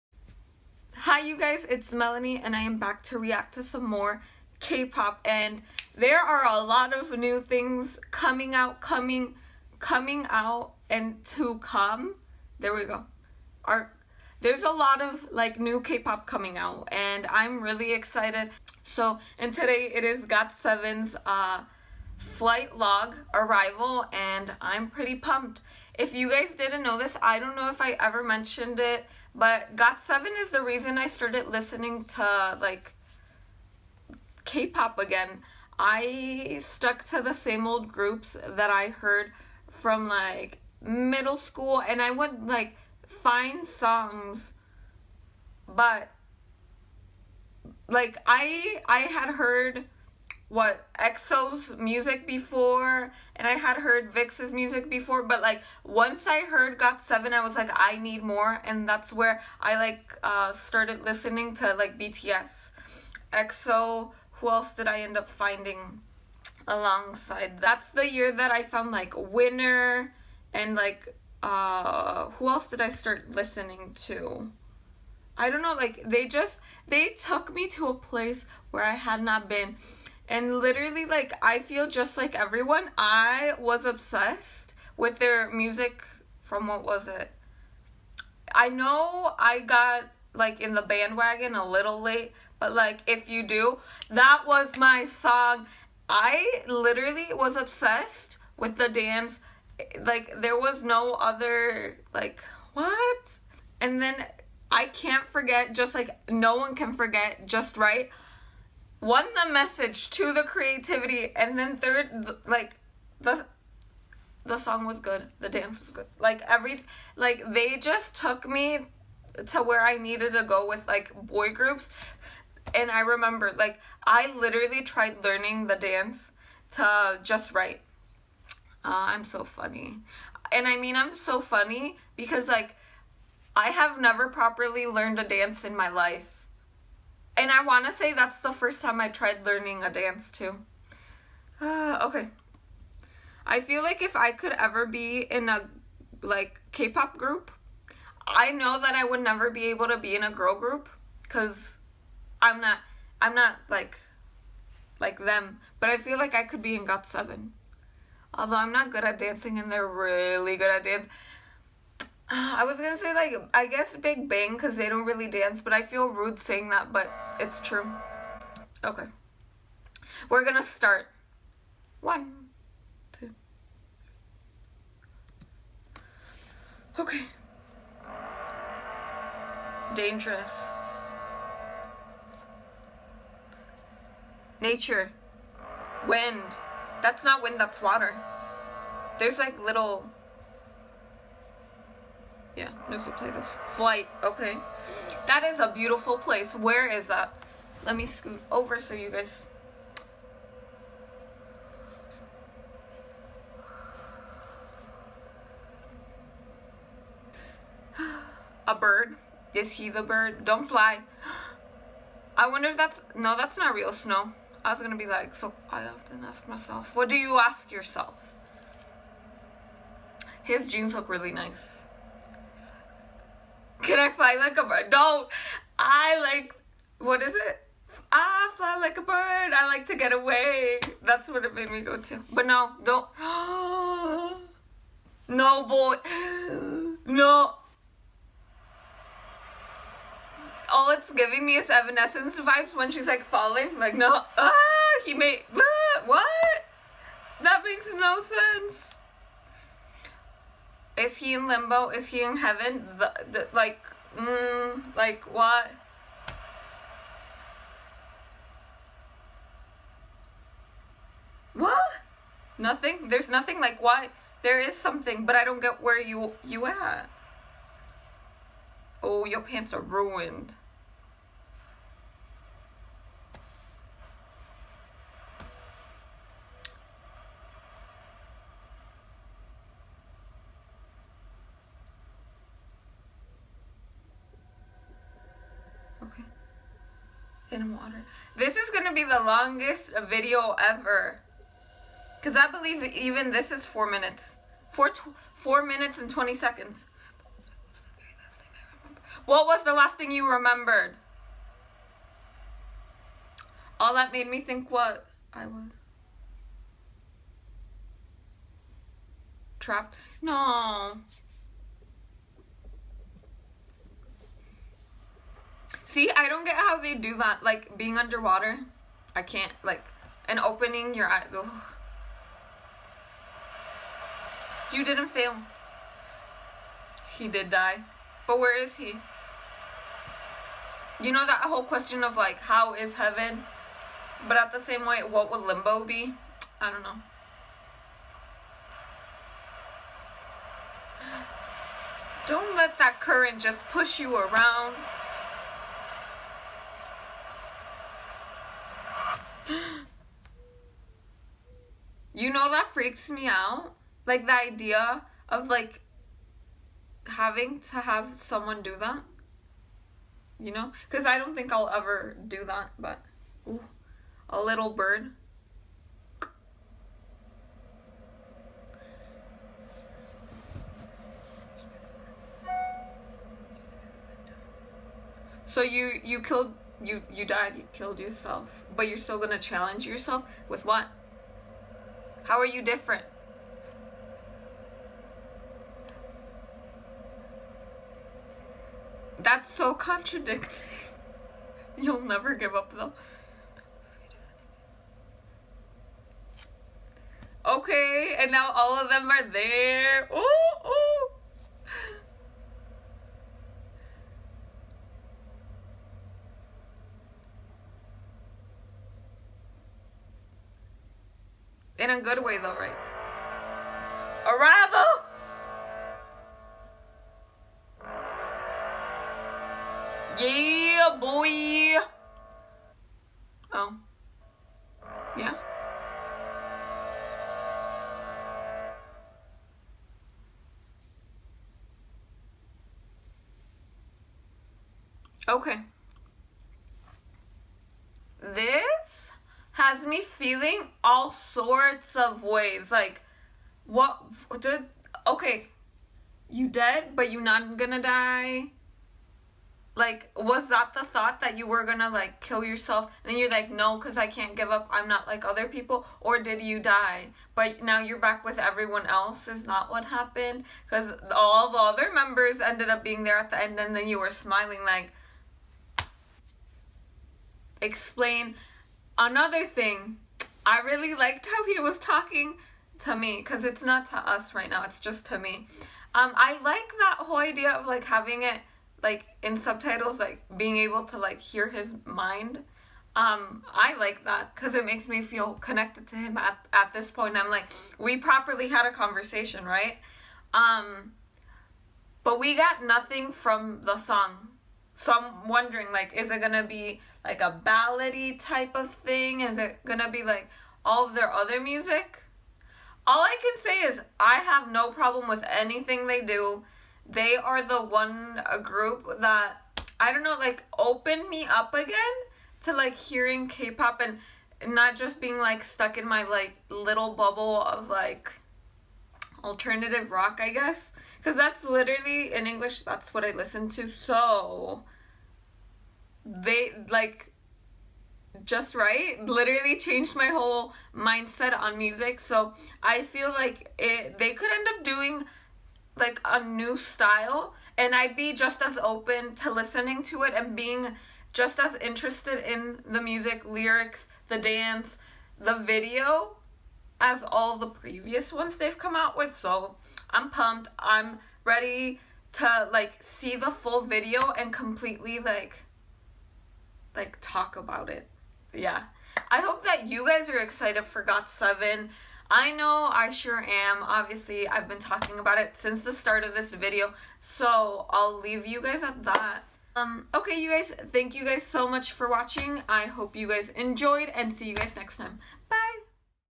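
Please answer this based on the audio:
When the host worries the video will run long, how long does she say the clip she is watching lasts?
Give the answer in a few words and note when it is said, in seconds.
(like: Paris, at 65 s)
4 minutes and 20 seconds, at 295 s.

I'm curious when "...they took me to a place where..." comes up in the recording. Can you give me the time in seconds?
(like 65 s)
76 s.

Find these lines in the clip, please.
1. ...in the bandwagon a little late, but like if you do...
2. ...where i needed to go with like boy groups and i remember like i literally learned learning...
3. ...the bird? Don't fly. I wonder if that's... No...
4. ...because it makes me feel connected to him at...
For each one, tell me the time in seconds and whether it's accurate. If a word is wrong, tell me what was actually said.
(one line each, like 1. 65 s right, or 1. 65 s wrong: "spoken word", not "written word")
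1. 90 s right
2. 119 s wrong: "tried", not "learned"
3. 209 s right
4. 484 s right.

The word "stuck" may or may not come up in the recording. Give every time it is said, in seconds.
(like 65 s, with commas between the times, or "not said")
36 s, 515 s.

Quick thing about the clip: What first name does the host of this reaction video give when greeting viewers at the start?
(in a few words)
Melany.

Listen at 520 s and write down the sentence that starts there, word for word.
Because that's literally in English, that's what I listen to.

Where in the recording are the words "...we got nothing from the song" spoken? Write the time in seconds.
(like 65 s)
492 s.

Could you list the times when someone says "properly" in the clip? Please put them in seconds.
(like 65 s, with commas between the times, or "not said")
134 s, 487 s.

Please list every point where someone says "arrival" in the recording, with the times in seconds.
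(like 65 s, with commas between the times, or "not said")
23 s, 414 s.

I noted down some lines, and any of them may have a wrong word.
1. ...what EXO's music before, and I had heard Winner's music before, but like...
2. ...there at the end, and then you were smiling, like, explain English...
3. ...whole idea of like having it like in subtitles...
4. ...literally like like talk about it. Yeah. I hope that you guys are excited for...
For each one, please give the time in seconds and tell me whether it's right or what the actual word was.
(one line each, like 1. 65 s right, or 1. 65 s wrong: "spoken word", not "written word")
1. 50 s wrong: "VIXX", not "Winner"
2. 463 s wrong: "Another", not "English"
3. 476 s right
4. 554 s wrong: "completely", not "literally".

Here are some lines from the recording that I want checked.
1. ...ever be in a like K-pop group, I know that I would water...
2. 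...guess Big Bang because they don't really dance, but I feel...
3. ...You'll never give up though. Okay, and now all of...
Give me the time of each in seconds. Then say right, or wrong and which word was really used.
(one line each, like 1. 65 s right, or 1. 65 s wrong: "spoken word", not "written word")
1. 144 s wrong: "never", not "water"
2. 163 s right
3. 391 s right.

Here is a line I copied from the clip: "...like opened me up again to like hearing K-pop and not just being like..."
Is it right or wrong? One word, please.
right.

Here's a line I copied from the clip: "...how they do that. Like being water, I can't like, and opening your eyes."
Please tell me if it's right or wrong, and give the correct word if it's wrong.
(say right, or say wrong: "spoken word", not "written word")
wrong: "underwater", not "water".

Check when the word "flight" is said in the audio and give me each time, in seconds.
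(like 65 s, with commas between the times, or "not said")
22 s, 193 s.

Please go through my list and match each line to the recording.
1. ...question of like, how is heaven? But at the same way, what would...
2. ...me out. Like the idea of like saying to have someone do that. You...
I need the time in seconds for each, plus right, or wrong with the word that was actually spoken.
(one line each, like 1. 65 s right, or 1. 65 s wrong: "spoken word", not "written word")
1. 331 s right
2. 353 s wrong: "having", not "saying".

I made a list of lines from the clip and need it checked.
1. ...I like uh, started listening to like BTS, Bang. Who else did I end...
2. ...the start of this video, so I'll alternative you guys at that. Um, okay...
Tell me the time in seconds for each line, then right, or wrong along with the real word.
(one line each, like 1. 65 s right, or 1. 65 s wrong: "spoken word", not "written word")
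1. 59 s wrong: "EXO", not "Bang"
2. 565 s wrong: "leave", not "alternative".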